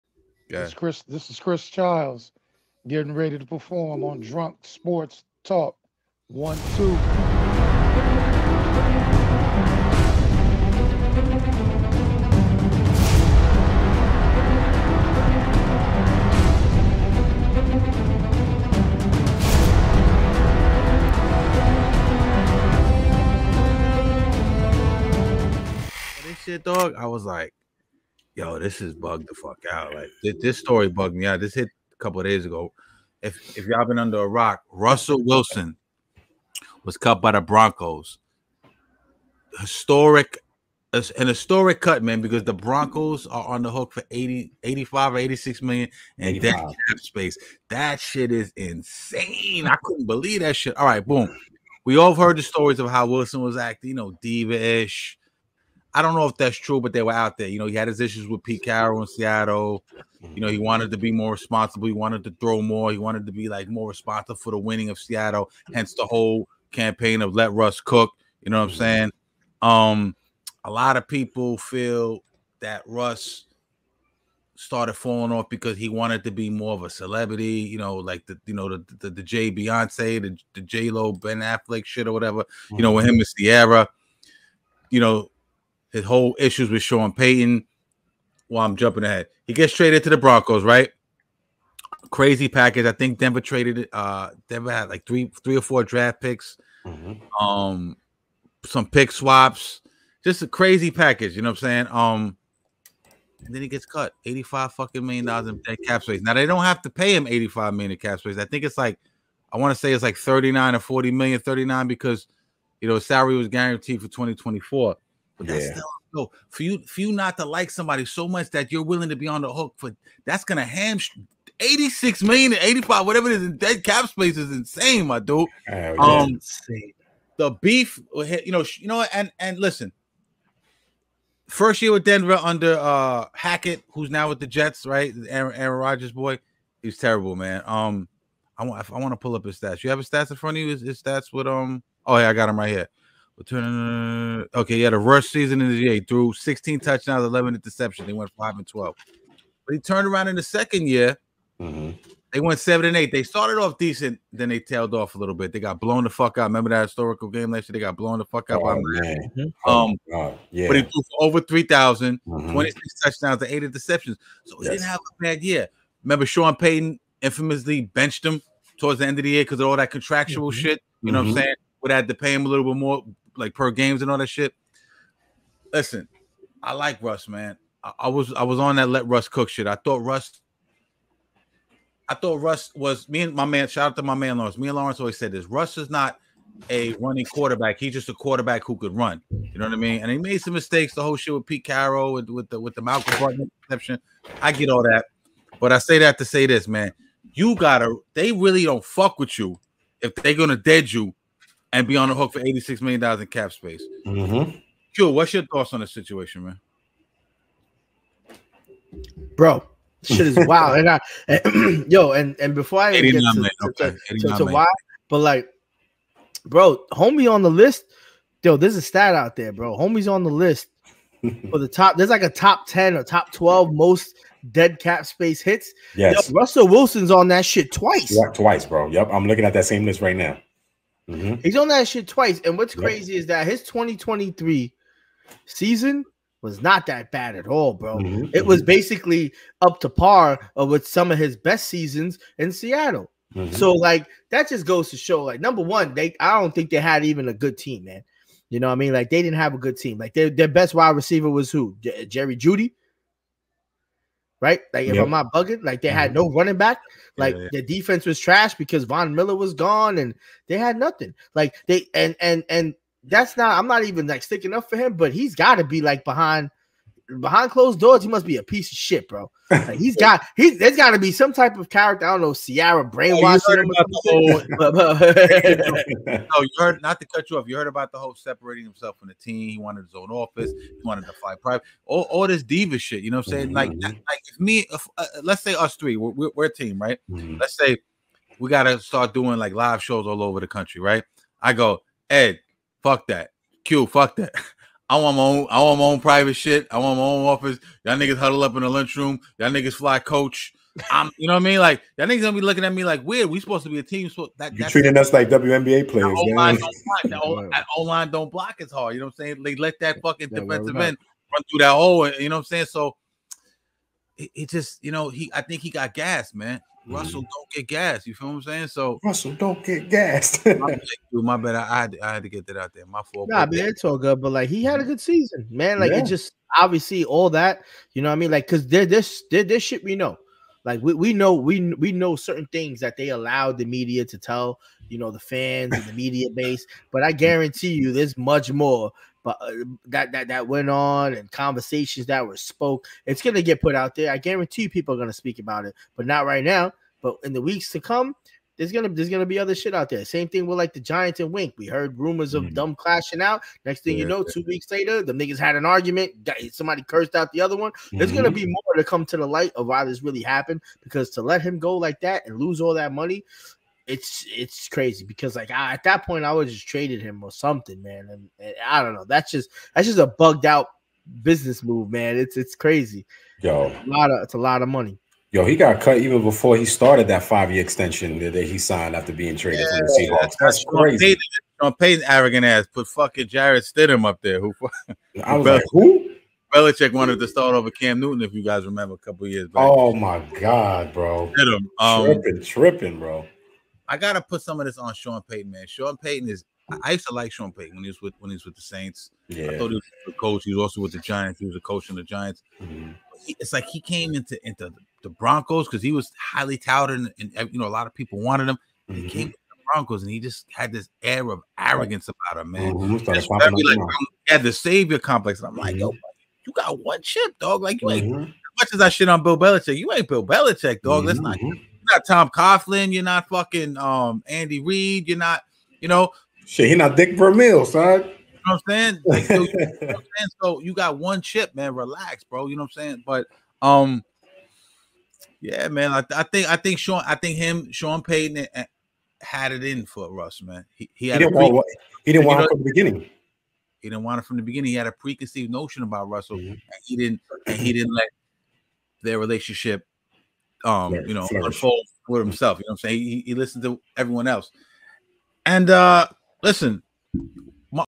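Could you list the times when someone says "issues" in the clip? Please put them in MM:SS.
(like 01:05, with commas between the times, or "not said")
00:57, 01:26.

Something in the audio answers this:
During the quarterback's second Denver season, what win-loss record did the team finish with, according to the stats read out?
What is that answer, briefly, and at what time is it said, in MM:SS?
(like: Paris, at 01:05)
7-8, at 02:32.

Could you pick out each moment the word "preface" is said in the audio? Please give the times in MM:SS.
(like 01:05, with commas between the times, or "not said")
not said.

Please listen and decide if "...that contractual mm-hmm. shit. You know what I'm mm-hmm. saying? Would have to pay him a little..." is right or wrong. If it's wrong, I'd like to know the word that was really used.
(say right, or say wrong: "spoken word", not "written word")
right.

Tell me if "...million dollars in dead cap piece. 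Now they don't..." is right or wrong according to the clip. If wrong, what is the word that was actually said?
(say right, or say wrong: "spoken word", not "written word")
wrong: "space", not "piece".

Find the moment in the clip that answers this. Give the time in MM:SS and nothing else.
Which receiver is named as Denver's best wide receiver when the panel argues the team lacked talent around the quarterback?
04:12.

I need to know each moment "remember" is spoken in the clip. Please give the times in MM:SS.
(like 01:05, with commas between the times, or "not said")
02:36, 02:46, 06:28.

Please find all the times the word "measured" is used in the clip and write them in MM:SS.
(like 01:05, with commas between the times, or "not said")
not said.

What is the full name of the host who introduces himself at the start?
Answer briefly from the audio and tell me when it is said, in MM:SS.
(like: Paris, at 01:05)
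Chris Childs, at 00:01.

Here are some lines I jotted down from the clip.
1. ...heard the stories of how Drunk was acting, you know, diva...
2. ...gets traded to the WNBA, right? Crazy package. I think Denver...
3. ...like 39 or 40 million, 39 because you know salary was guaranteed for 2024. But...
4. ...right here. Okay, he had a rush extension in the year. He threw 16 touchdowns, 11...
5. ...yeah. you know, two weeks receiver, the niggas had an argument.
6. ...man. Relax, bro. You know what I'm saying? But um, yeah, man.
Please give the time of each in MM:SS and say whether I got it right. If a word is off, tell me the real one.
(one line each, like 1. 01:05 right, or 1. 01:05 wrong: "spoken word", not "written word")
1. 00:52 wrong: "Wilson", not "Drunk"
2. 01:29 wrong: "Broncos", not "WNBA"
3. 01:50 right
4. 02:22 wrong: "season", not "extension"
5. 05:53 wrong: "later", not "receiver"
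6. 07:11 right.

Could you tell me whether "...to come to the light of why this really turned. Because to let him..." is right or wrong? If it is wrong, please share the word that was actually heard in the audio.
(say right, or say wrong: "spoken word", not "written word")
wrong: "happened", not "turned".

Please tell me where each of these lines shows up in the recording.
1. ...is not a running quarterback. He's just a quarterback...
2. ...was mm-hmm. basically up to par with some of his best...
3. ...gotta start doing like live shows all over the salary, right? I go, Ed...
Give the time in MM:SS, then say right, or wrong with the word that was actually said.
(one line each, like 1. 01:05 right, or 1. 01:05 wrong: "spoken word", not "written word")
1. 03:05 right
2. 03:58 right
3. 04:48 wrong: "country", not "salary".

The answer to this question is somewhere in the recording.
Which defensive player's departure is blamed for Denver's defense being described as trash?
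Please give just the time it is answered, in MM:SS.
04:18.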